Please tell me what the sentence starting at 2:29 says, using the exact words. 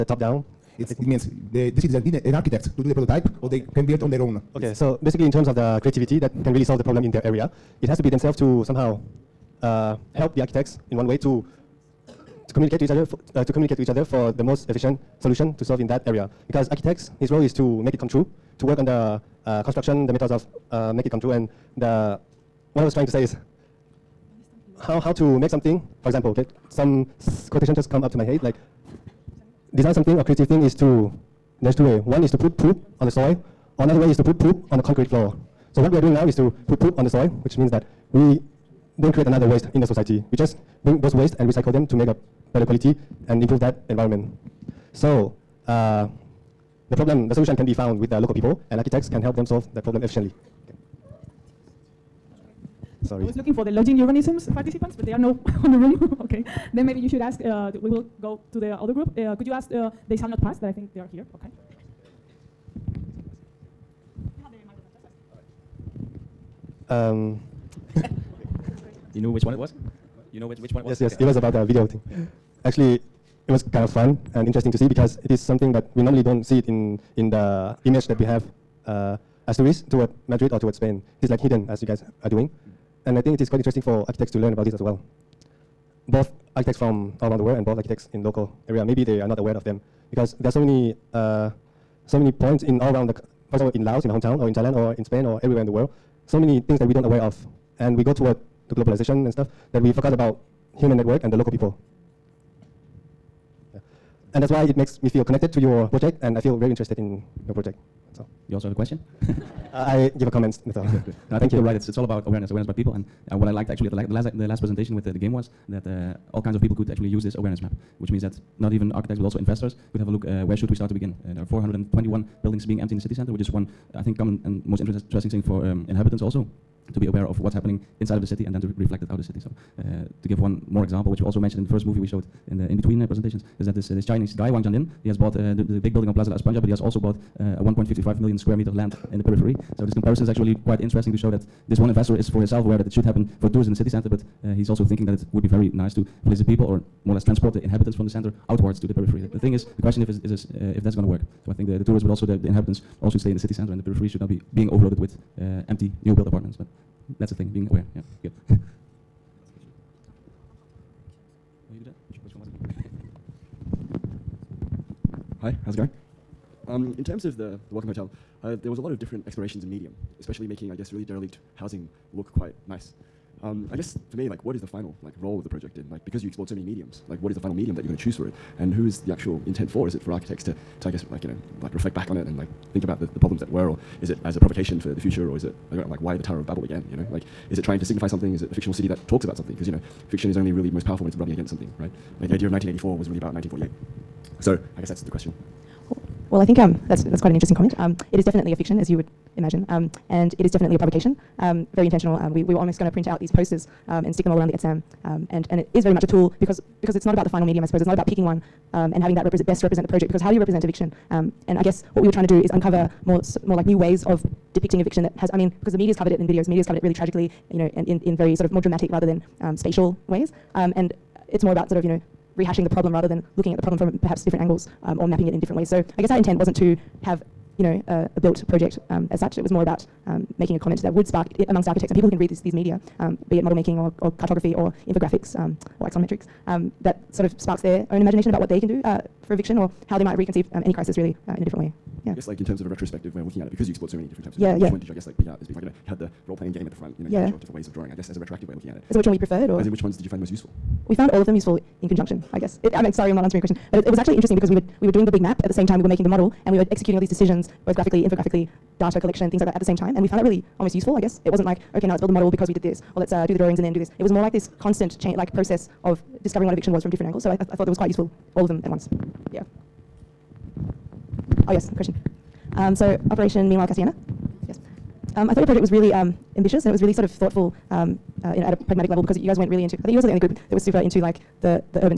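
The, the thing is, the question if is, is this, uh, if that's going to work.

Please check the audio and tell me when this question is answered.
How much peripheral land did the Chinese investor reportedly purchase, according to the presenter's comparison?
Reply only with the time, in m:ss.
2:17.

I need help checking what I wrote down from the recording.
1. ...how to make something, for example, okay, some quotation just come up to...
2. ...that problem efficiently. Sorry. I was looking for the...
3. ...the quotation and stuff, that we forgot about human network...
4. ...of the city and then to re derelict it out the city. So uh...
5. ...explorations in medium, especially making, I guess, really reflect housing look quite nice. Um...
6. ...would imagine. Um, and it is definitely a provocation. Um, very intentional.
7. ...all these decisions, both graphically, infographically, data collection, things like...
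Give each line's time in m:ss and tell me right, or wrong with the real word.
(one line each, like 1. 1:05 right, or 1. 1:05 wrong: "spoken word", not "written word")
1. 0:24 right
2. 0:49 right
3. 1:38 wrong: "globalization", not "quotation"
4. 2:08 wrong: "reflect", not "derelict"
5. 2:49 wrong: "derelict", not "reflect"
6. 3:18 right
7. 4:16 right.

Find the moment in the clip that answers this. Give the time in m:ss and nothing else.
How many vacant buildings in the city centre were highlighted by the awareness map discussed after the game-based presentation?
2:01.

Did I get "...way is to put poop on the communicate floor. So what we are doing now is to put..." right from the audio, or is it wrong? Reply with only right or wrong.
wrong.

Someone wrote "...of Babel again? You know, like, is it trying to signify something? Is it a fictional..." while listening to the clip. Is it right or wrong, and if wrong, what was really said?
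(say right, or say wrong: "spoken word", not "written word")
right.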